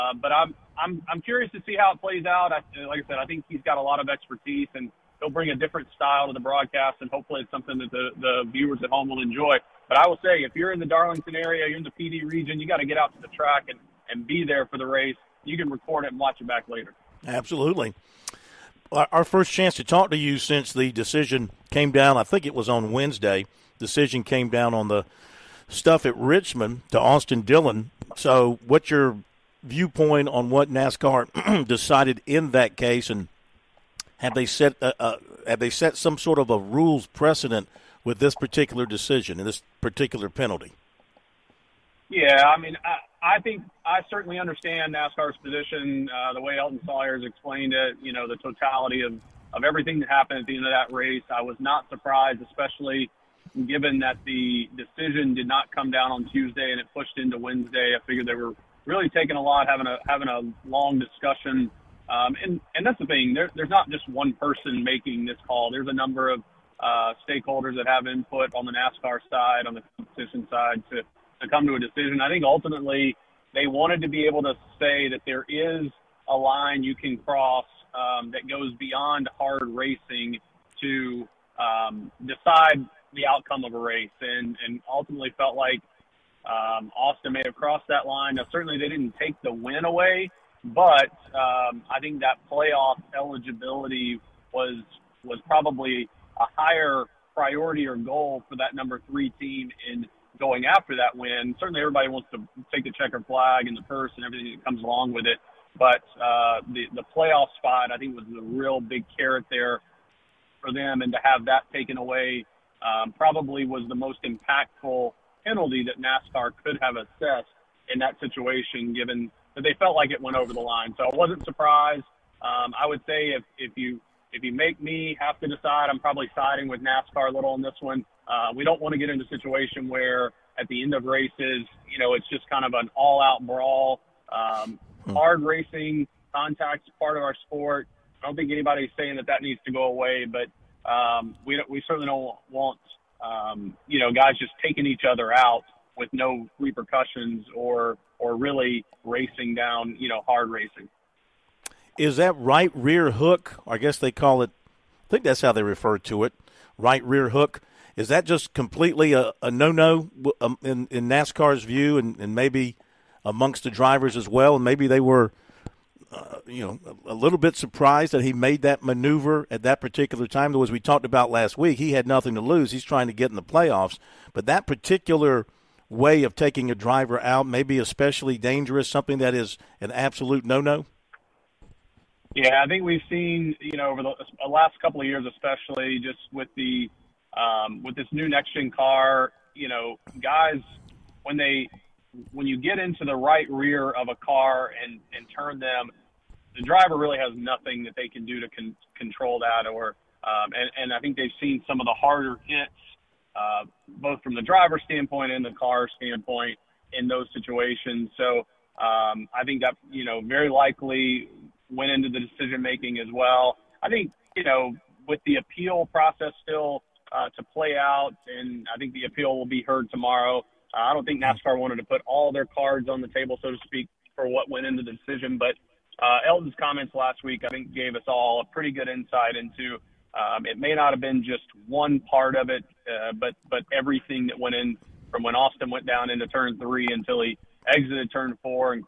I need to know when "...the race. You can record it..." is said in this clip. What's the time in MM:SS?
00:14.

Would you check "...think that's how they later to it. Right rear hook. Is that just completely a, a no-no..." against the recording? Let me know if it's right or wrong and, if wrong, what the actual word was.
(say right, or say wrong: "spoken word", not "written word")
wrong: "refer", not "later".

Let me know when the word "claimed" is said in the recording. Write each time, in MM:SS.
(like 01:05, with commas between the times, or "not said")
not said.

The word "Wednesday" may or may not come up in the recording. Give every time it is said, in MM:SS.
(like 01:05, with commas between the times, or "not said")
00:22, 00:57.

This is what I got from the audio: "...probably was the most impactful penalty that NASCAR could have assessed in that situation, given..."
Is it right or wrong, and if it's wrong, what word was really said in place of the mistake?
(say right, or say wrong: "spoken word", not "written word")
right.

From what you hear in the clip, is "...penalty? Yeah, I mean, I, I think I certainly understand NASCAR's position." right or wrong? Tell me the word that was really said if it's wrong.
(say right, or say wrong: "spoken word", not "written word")
right.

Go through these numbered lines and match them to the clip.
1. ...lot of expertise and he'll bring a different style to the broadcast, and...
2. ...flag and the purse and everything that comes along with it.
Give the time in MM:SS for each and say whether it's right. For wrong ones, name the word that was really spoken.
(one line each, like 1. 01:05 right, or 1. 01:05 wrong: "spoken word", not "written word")
1. 00:03 right
2. 01:43 right.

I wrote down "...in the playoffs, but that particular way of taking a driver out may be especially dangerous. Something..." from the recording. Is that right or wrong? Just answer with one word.
right.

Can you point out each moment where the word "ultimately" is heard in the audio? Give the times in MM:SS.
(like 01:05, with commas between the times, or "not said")
01:12, 01:24.